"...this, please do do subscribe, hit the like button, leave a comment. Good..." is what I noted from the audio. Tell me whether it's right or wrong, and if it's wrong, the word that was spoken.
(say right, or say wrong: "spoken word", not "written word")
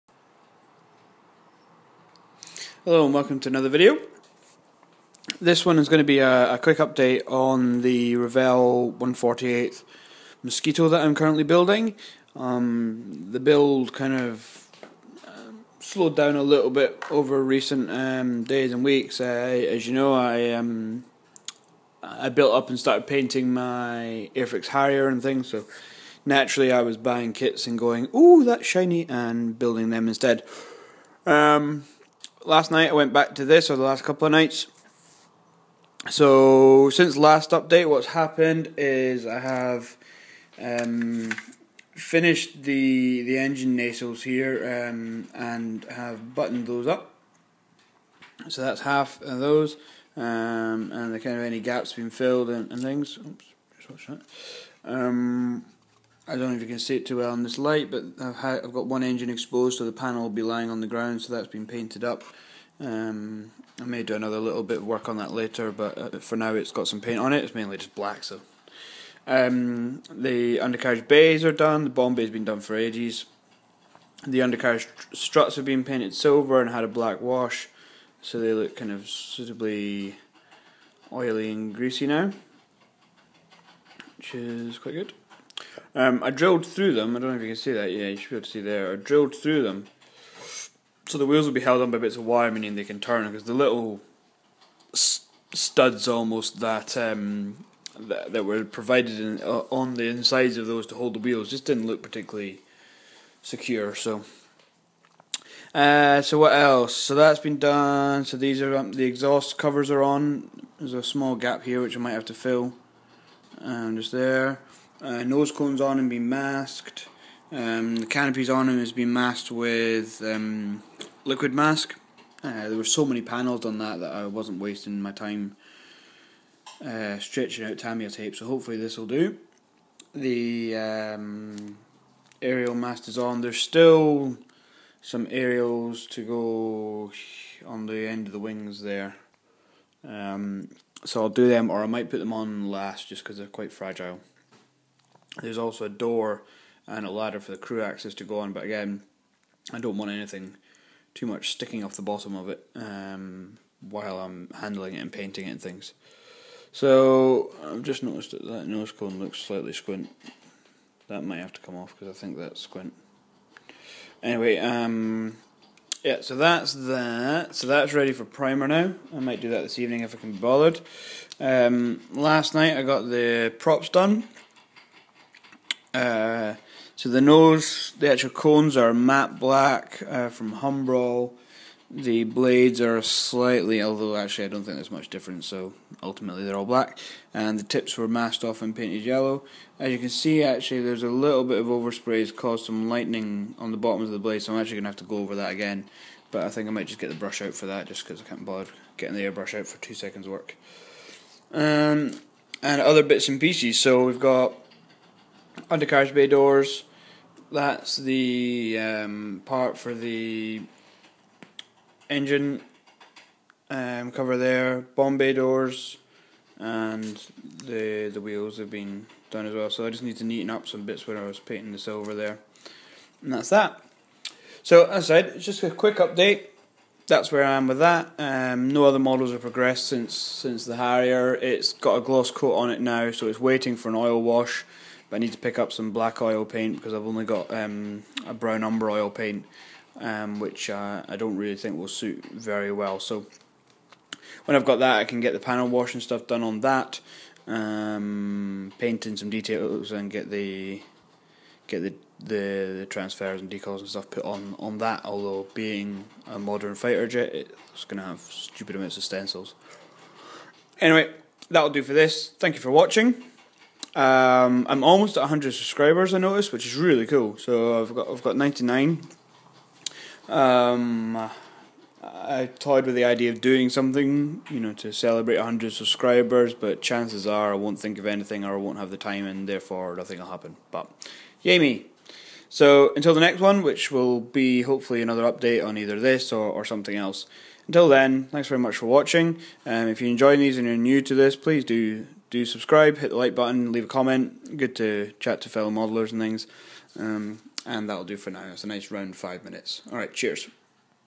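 right.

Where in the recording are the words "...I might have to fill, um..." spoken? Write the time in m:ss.
1:51.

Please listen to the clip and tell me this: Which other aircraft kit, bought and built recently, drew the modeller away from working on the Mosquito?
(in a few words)
Airfix Harrier.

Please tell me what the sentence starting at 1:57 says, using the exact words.
Um, the canopy's on and has been masked with um, liquid mask.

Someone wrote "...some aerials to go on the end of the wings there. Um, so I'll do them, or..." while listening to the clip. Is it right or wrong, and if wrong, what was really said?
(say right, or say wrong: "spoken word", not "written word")
right.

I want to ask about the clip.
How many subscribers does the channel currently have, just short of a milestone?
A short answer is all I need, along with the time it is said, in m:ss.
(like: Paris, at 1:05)
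99, at 4:28.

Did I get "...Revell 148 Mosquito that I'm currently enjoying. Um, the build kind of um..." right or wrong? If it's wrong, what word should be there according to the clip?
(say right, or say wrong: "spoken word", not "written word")
wrong: "building", not "enjoying".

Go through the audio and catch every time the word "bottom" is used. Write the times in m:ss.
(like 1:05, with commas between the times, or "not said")
2:32, 3:13.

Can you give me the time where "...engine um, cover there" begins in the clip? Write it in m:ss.
3:32.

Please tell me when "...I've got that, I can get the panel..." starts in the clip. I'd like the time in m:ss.
4:04.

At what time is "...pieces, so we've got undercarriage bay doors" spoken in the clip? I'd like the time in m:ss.
3:23.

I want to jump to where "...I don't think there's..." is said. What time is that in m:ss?
3:04.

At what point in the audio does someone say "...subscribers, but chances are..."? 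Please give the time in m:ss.
4:35.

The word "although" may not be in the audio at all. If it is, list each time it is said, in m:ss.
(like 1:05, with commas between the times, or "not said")
3:03, 4:15.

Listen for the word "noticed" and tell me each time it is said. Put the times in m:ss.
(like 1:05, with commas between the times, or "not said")
2:38, 4:26.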